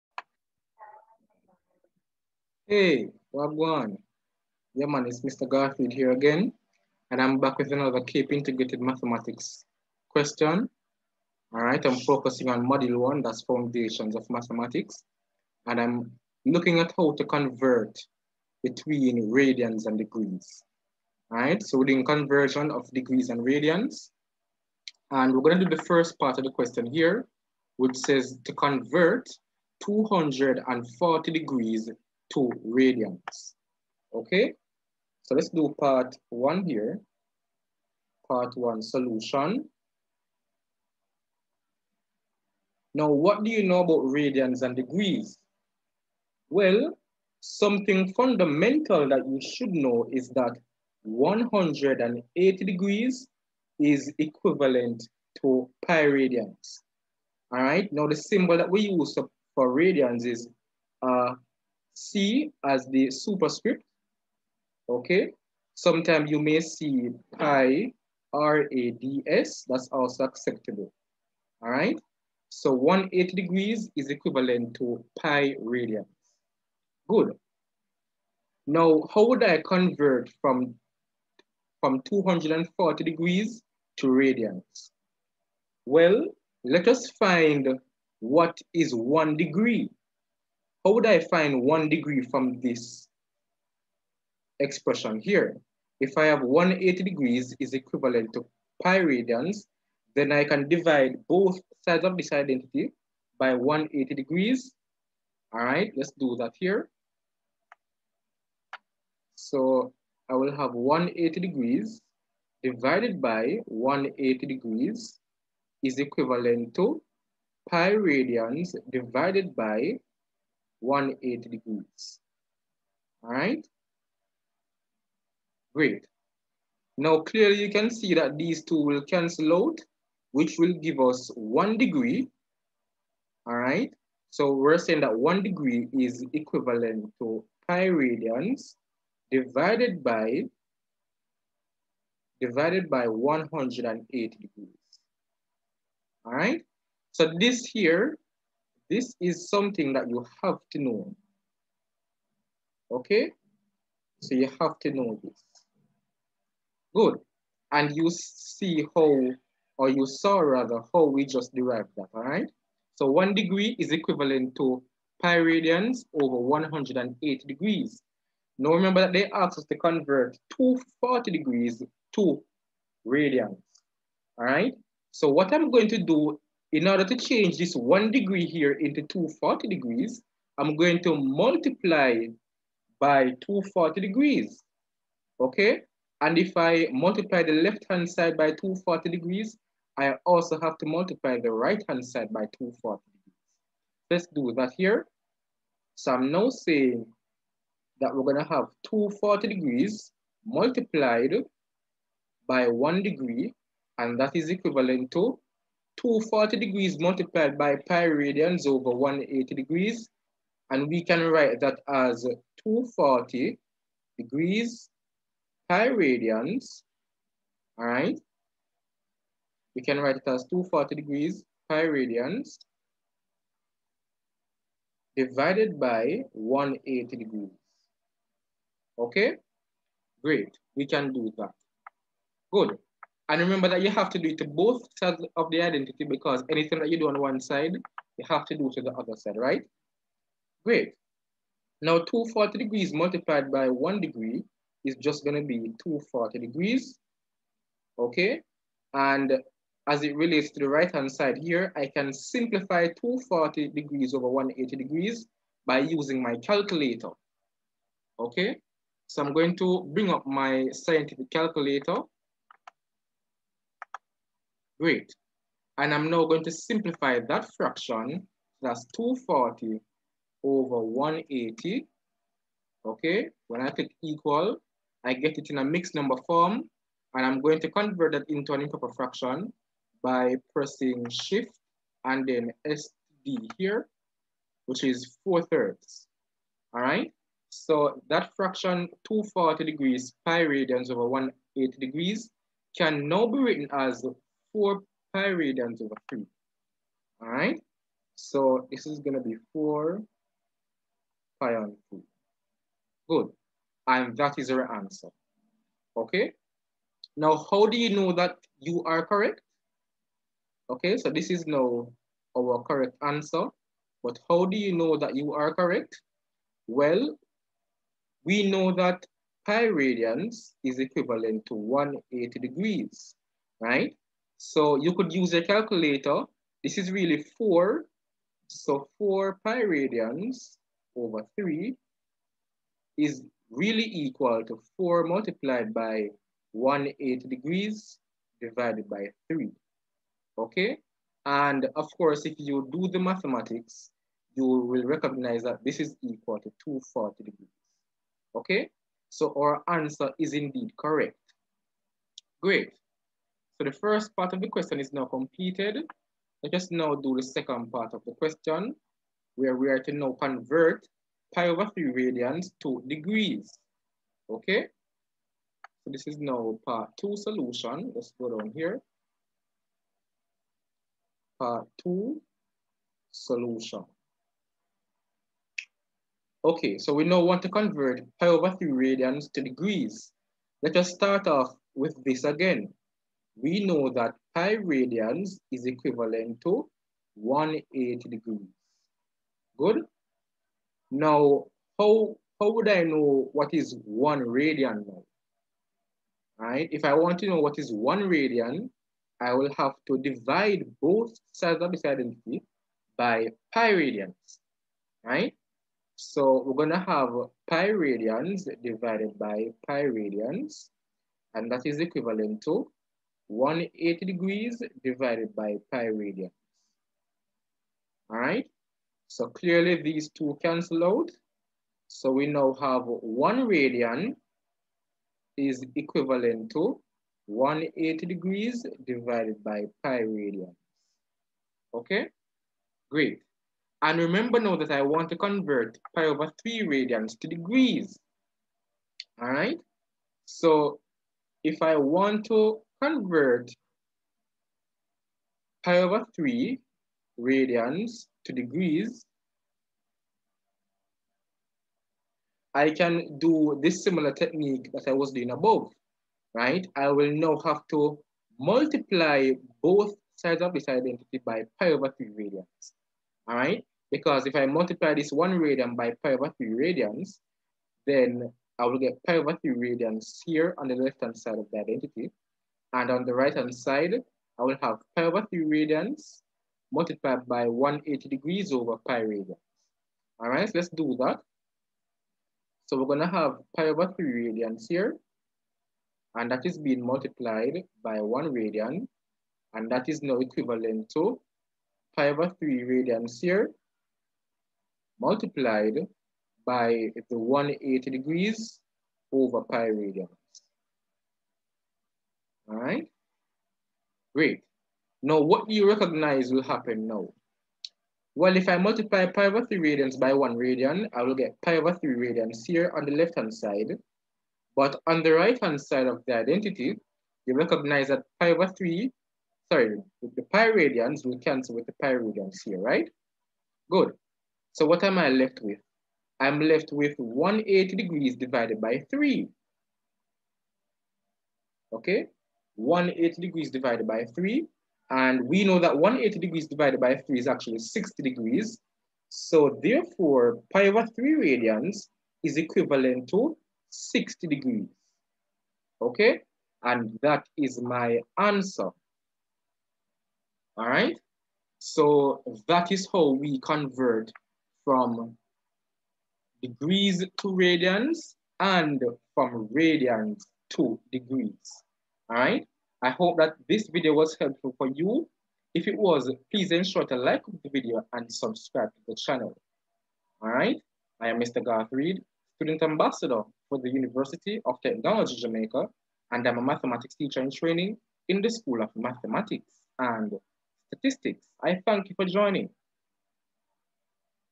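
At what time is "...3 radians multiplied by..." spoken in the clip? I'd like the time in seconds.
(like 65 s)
475 s.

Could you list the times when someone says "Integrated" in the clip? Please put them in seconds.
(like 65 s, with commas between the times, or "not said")
8 s.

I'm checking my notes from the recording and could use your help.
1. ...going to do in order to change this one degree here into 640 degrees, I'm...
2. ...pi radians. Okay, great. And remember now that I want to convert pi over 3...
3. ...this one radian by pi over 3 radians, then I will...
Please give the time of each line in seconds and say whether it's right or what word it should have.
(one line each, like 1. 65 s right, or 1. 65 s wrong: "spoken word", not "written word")
1. 175 s wrong: "240", not "640"
2. 429 s right
3. 464 s right.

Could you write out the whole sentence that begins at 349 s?
So our answer is indeed correct.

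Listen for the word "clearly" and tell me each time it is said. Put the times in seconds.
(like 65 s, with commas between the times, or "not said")
127 s, 419 s.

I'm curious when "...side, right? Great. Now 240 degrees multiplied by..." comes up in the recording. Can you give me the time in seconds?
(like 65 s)
239 s.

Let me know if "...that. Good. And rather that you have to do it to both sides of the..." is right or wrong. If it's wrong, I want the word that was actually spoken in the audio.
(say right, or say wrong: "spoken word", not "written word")
wrong: "remember", not "rather".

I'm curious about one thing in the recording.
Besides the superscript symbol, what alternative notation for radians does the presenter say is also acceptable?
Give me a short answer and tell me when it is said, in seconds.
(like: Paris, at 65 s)
pi RADS, at 67 s.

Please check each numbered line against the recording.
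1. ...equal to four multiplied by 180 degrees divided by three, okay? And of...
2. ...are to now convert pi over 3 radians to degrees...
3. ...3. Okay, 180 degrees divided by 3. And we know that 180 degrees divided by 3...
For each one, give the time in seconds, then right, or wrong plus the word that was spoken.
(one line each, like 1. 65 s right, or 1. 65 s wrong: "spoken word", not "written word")
1. 334 s right
2. 359 s right
3. 528 s right.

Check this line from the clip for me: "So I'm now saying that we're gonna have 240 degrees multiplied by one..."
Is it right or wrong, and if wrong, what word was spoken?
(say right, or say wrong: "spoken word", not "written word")
right.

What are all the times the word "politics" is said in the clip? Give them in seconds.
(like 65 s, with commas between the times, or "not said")
not said.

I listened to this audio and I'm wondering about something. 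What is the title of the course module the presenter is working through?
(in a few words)
Foundations of Mathematics.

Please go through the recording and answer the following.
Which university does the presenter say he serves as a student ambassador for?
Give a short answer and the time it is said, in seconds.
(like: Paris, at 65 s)
University of Technology Jamaica, at 573 s.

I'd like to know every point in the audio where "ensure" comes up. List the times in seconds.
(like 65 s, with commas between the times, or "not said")
566 s.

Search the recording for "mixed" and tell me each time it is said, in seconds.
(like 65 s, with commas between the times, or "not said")
275 s.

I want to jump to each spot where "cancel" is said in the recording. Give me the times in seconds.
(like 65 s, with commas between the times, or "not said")
129 s, 420 s, 521 s.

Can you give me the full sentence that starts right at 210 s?
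And we can write that as 240 degrees pi radians, all right?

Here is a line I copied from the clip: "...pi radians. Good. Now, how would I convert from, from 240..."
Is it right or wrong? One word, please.
right.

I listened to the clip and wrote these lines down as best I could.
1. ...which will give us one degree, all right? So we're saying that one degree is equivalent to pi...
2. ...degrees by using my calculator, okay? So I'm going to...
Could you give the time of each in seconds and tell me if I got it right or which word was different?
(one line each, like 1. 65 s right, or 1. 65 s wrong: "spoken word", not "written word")
1. 130 s right
2. 254 s right.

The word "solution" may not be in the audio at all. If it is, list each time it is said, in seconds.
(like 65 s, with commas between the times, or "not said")
38 s, 367 s, 373 s.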